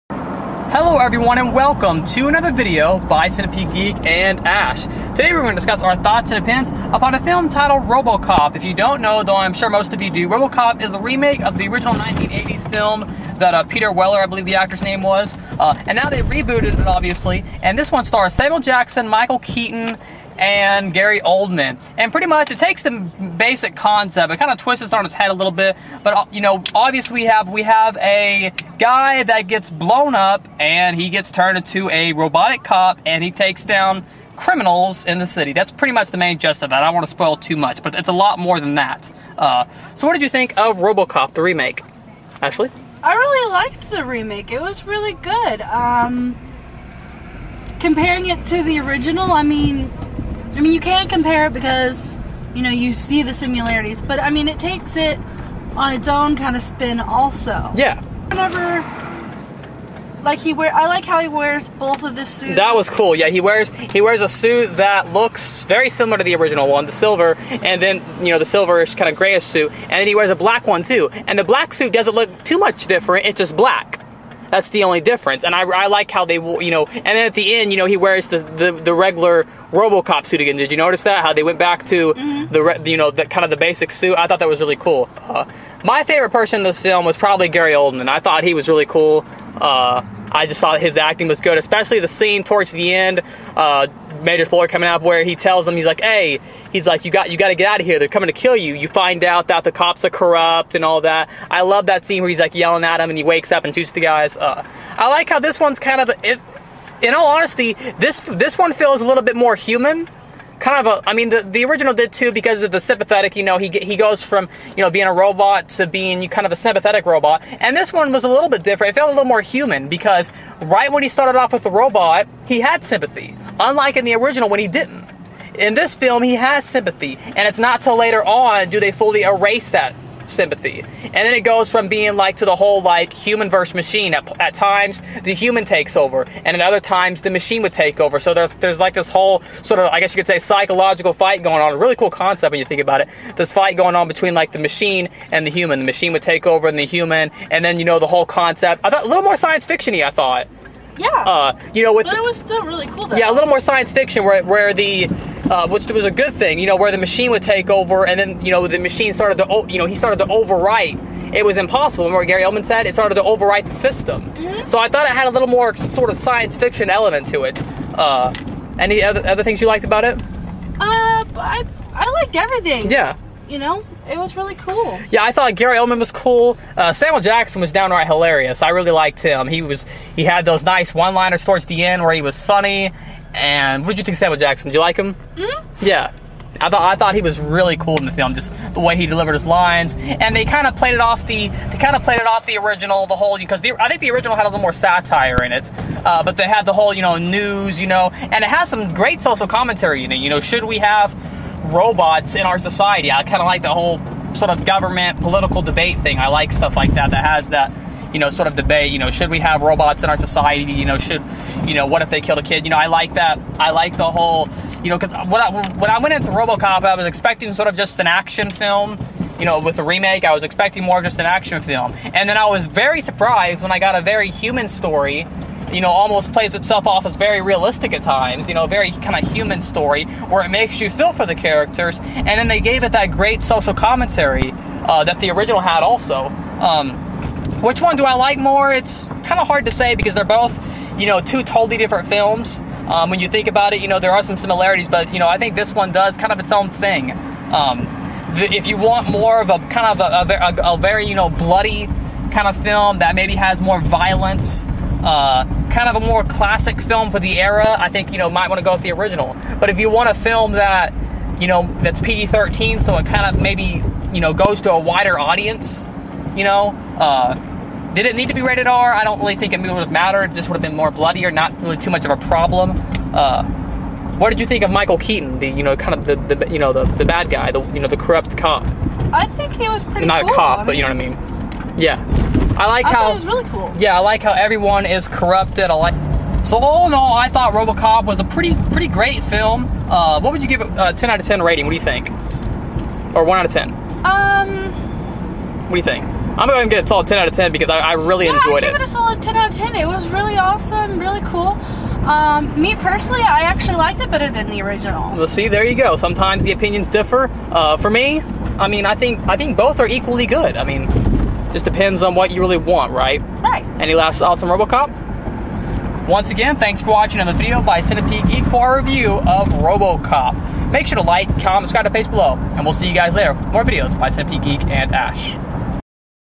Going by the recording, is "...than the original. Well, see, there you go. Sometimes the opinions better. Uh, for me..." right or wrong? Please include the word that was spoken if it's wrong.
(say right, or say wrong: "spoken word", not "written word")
wrong: "differ", not "better".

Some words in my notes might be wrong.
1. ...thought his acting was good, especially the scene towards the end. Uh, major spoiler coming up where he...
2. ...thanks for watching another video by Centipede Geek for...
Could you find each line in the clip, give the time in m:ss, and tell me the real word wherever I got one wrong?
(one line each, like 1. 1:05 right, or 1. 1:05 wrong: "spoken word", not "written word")
1. 1:30 right
2. 5:16 right.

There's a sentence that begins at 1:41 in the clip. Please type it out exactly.
I love that scene where he's like yelling at him and he wakes up and shoots the guys.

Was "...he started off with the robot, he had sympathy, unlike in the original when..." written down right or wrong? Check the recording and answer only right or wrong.
right.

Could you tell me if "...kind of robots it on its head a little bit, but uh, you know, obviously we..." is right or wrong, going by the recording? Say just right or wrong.
wrong.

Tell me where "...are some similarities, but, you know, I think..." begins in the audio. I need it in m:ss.
4:04.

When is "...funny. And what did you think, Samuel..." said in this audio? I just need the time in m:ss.
3:02.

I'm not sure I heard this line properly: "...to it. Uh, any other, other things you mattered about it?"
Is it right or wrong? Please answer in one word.
wrong.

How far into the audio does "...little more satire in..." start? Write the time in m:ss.
3:14.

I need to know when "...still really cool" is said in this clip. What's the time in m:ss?
2:32.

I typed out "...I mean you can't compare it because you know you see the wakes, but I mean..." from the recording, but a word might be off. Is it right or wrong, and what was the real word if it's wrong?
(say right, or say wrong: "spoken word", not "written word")
wrong: "similarities", not "wakes".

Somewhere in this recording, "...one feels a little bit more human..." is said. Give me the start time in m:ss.
1:48.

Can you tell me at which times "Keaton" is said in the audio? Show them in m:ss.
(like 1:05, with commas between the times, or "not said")
0:19, 4:34.